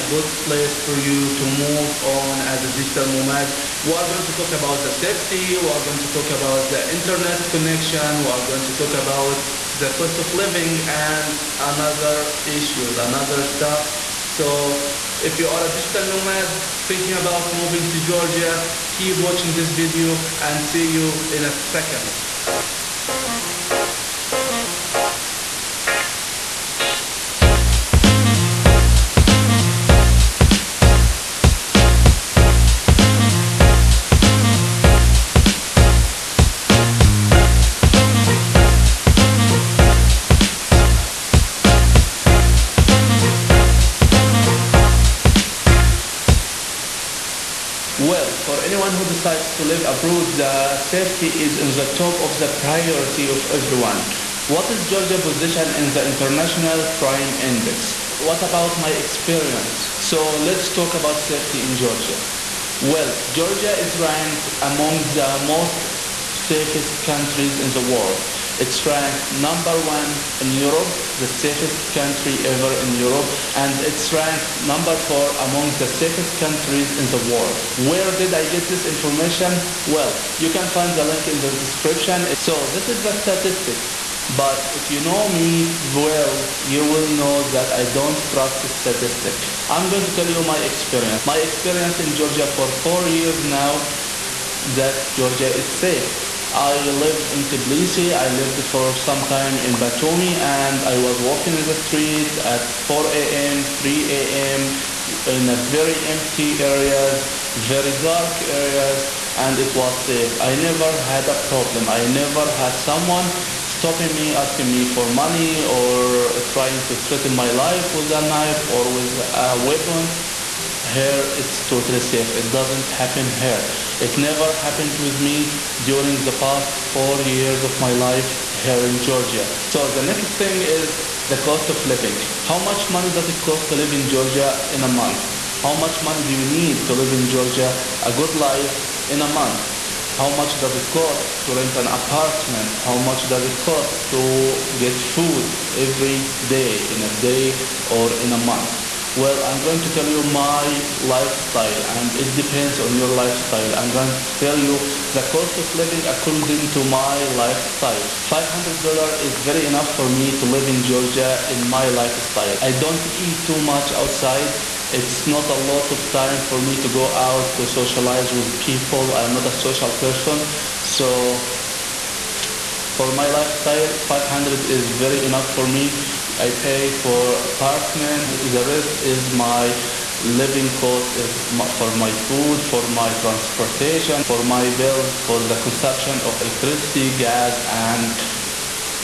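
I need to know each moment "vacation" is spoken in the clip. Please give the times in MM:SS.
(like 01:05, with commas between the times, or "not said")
not said.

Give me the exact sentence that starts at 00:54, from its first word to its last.
What is Georgia's position in the International Crime Index?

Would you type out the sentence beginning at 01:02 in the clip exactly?
Well, Georgia is ranked among the most safest countries in the world.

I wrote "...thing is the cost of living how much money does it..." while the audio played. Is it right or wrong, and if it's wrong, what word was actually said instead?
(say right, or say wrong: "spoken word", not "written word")
right.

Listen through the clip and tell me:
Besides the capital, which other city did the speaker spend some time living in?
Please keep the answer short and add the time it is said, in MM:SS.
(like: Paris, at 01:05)
Batumi, at 01:39.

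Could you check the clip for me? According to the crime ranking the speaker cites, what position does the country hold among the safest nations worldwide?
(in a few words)
4.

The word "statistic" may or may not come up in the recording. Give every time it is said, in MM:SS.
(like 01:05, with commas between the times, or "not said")
01:23, 01:28.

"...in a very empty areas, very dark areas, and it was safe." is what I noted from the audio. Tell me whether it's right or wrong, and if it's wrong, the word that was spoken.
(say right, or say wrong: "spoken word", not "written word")
right.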